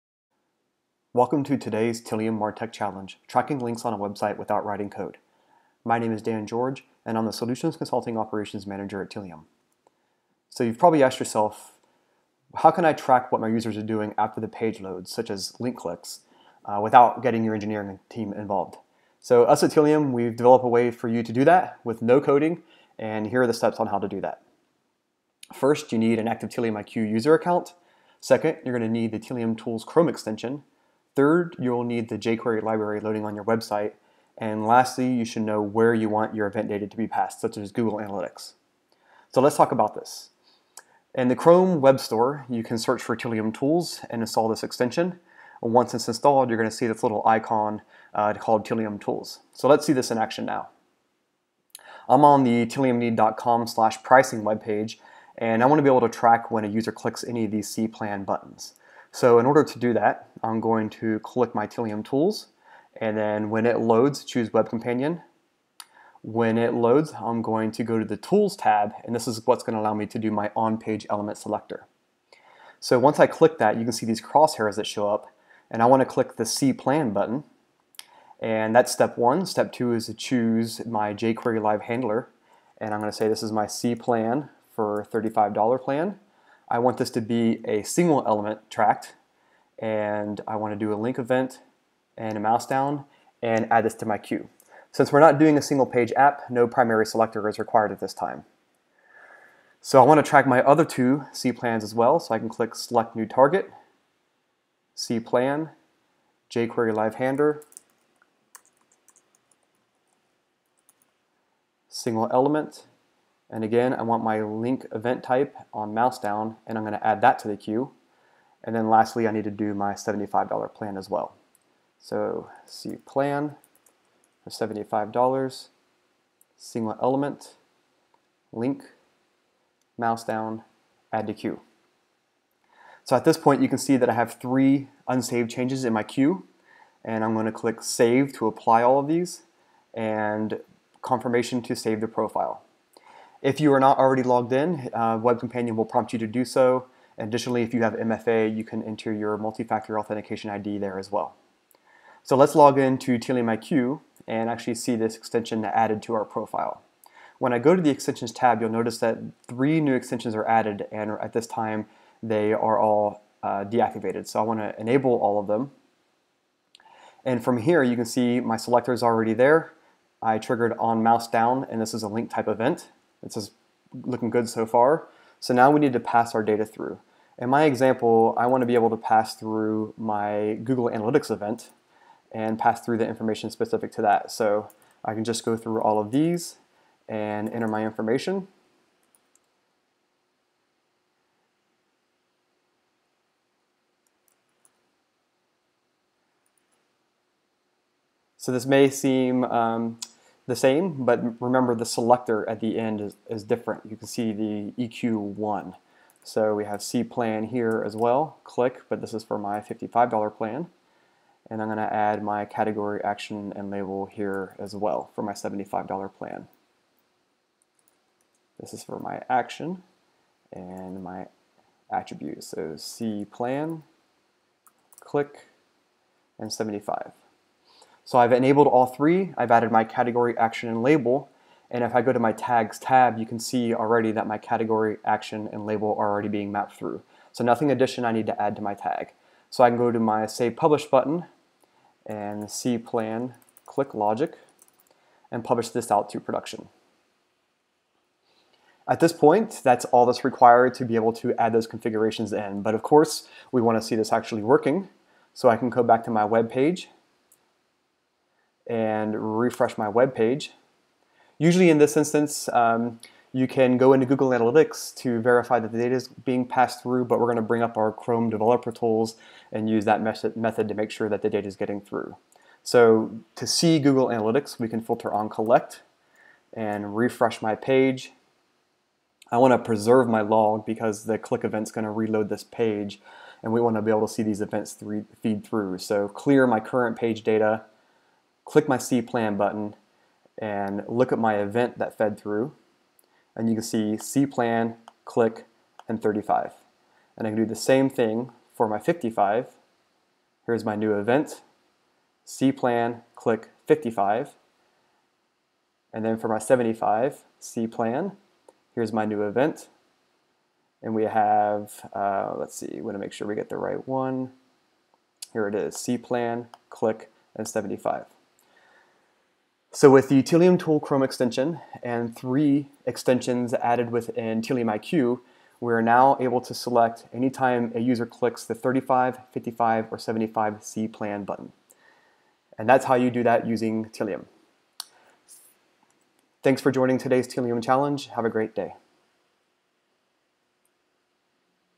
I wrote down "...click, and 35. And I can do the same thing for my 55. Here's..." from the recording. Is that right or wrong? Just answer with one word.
right.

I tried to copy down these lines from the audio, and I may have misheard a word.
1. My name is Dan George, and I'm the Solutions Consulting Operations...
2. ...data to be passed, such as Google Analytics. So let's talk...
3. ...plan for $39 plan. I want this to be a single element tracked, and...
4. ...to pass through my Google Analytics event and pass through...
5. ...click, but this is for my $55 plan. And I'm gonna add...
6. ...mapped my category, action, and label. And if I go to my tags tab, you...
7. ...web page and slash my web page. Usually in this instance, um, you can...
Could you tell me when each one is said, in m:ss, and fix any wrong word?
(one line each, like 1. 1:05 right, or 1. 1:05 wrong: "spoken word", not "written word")
1. 0:05 right
2. 0:36 right
3. 1:23 wrong: "35", not "39"
4. 2:58 right
5. 3:28 right
6. 3:49 wrong: "added", not "mapped"
7. 4:16 wrong: "refresh", not "slash".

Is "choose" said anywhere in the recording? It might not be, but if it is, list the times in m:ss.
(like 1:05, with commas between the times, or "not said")
1:04, 1:20.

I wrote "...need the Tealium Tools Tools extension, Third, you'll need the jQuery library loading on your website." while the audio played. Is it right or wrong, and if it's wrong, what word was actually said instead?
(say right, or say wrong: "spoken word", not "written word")
wrong: "Chrome", not "Tools".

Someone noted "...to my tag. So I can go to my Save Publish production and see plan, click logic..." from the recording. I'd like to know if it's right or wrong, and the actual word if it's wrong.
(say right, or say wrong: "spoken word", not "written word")
wrong: "button", not "production".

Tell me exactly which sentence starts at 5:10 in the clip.
And we have, uh, let's see, we want to make sure we get the right one.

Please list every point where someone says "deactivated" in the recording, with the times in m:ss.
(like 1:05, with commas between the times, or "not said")
2:43.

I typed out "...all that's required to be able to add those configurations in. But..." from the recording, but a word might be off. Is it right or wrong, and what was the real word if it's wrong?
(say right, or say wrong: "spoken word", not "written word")
right.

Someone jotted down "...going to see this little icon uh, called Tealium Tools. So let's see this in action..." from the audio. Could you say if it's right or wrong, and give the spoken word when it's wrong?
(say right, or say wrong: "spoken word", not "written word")
right.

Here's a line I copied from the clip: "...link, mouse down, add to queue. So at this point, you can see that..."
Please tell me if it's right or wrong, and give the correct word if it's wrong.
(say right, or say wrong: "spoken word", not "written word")
right.